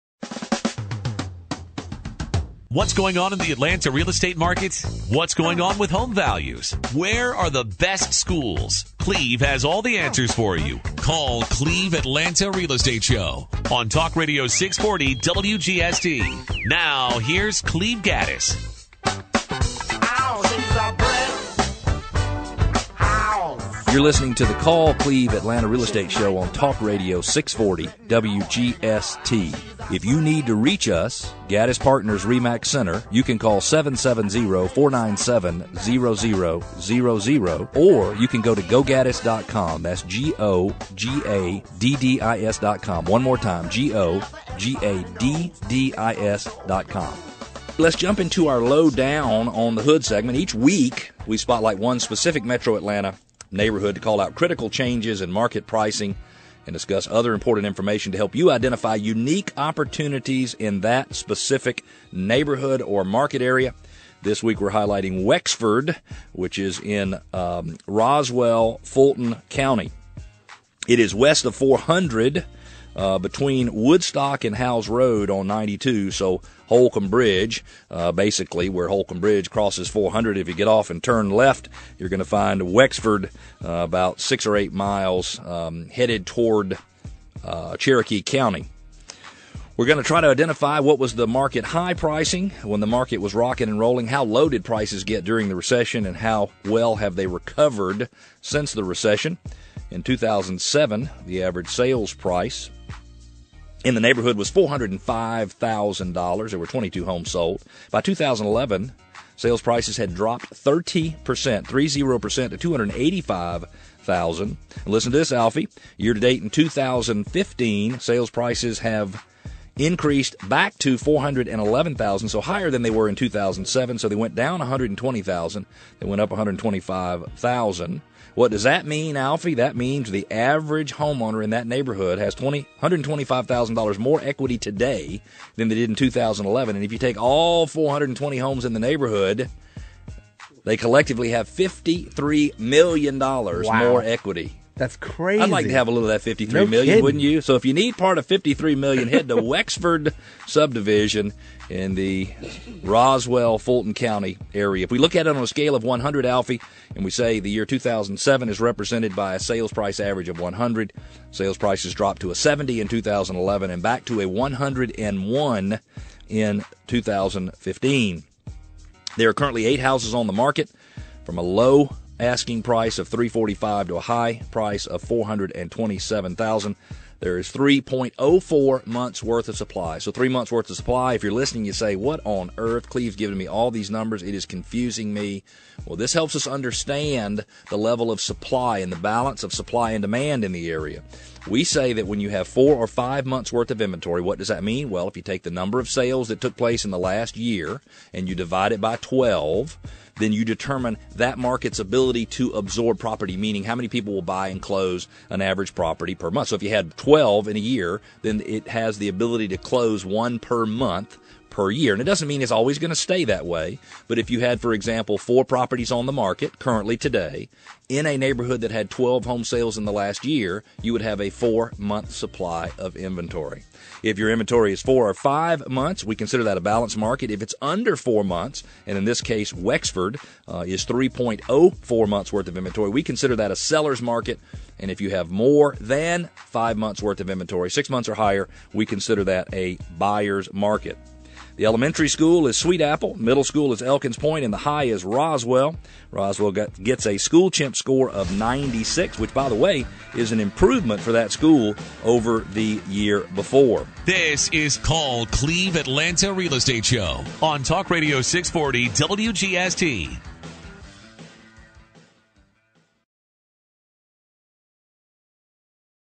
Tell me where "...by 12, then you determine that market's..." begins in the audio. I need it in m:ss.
3:18.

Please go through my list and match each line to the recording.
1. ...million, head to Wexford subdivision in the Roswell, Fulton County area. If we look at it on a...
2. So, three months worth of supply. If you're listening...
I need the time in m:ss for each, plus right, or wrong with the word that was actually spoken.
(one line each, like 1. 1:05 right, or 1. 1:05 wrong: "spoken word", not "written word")
1. 2:28 right
2. 2:59 right.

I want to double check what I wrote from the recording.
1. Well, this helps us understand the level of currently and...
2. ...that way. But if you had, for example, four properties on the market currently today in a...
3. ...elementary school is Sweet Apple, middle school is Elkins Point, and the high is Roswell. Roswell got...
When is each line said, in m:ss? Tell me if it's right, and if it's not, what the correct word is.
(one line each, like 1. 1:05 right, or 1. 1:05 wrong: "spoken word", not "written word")
1. 3:05 wrong: "supply", not "currently"
2. 3:33 right
3. 4:01 right.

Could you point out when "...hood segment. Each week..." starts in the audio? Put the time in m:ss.
0:49.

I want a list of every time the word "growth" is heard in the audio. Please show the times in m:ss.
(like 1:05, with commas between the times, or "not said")
not said.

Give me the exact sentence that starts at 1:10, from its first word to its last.
It is west of 400 uh, between Woodstock and Howes Road on 92.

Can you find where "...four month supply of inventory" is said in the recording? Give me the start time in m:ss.
3:41.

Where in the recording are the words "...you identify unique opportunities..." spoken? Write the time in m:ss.
0:58.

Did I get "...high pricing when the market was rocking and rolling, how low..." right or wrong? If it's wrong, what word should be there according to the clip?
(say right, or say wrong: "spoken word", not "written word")
right.